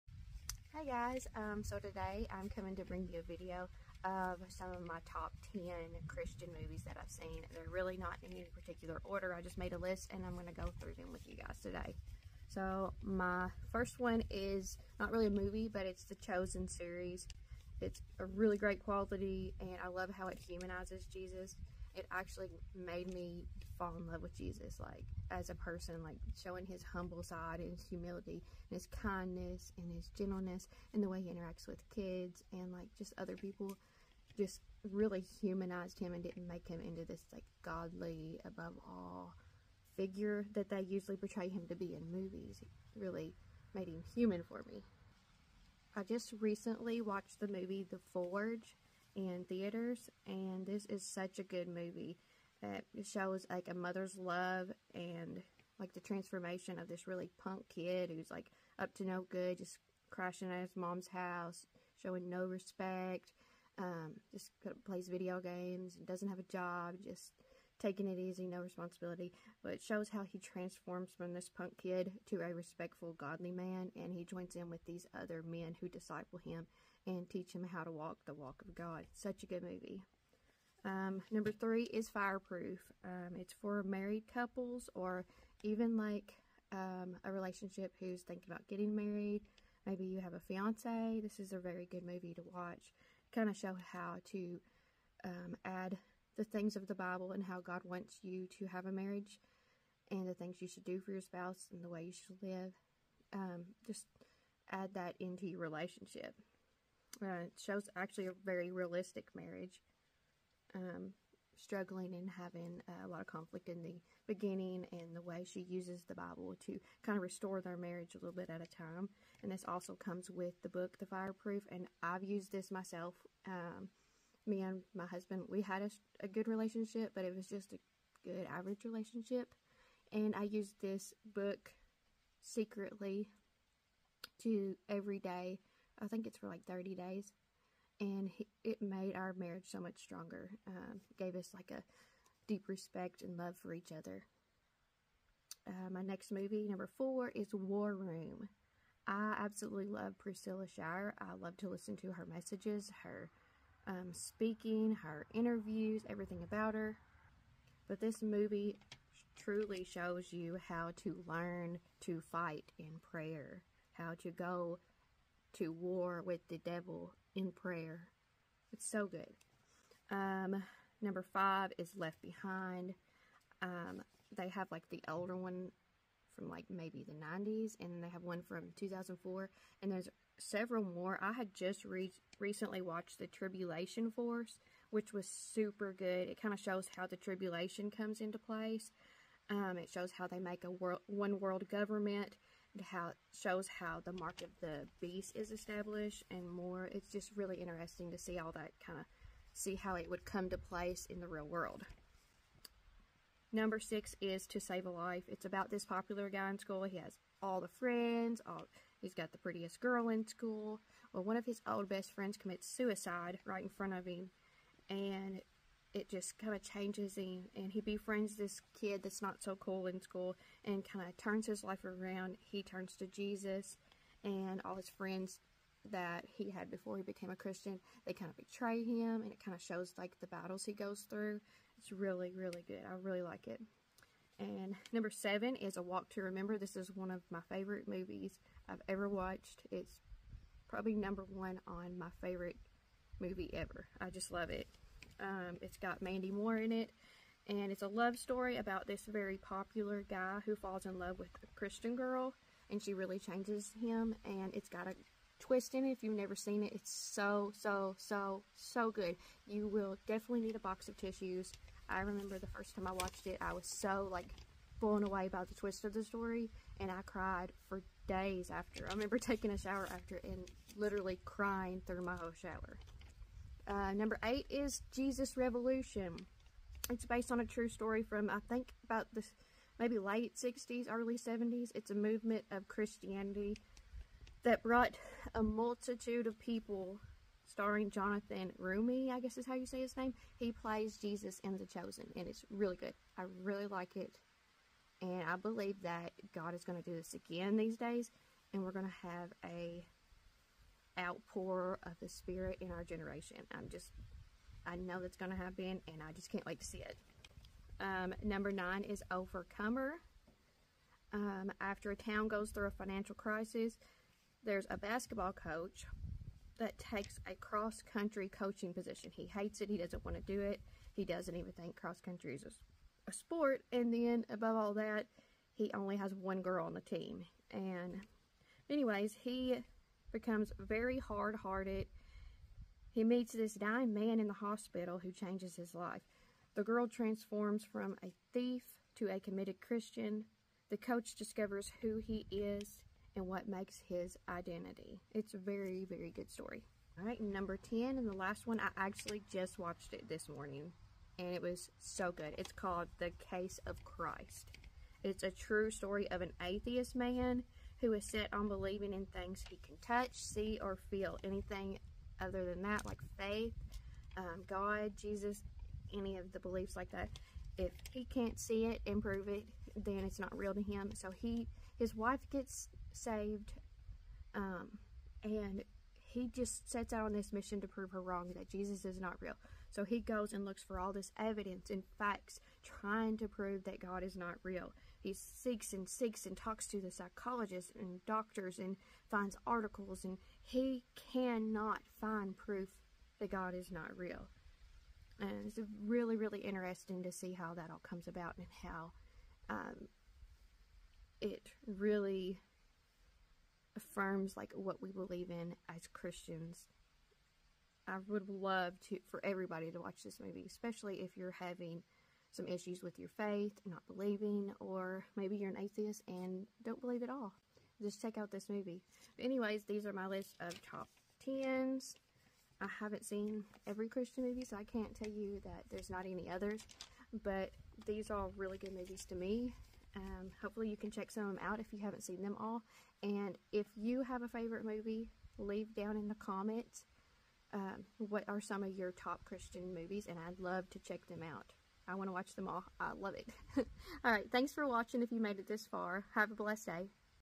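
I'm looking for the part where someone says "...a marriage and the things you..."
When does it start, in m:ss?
1:38.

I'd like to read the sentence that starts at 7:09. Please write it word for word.
Um, hopefully you can check some of them out if you haven't seen them all.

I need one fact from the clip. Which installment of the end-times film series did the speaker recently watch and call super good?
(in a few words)
The Tribulation Force.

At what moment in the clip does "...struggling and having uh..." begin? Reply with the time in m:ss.
1:51.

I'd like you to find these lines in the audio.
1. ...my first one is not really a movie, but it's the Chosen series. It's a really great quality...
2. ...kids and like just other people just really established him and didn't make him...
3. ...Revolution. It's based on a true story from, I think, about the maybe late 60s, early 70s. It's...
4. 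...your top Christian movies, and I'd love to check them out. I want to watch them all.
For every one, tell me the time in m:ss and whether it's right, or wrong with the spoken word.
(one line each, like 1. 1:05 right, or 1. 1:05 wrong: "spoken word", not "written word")
1. 0:13 right
2. 0:31 wrong: "humanized", not "established"
3. 4:35 right
4. 7:18 right.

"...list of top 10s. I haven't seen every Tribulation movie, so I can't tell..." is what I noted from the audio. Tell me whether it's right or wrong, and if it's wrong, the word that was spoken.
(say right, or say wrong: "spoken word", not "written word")
wrong: "Christian", not "Tribulation".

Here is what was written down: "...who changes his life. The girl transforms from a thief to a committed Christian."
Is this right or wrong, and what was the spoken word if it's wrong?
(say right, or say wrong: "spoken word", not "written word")
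right.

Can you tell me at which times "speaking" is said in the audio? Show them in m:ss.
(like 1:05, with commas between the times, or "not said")
2:34.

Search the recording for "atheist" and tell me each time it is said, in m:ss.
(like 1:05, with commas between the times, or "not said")
5:56, 6:55.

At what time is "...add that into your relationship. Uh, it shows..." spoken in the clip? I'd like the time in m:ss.
1:44.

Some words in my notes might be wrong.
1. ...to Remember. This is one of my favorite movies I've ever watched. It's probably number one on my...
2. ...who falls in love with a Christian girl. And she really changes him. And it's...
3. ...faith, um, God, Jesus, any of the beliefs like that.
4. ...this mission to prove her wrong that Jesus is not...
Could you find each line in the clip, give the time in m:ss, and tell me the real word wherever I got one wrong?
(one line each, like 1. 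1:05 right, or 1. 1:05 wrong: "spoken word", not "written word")
1. 3:56 right
2. 4:10 right
3. 6:03 right
4. 6:17 right.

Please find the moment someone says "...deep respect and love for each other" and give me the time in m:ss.
2:22.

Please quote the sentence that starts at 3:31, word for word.
Well, one of his old best friends commits suicide right in front of him.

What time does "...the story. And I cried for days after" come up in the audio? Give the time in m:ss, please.
4:25.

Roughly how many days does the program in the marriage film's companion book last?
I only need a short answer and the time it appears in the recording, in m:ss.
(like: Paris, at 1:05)
30, at 2:16.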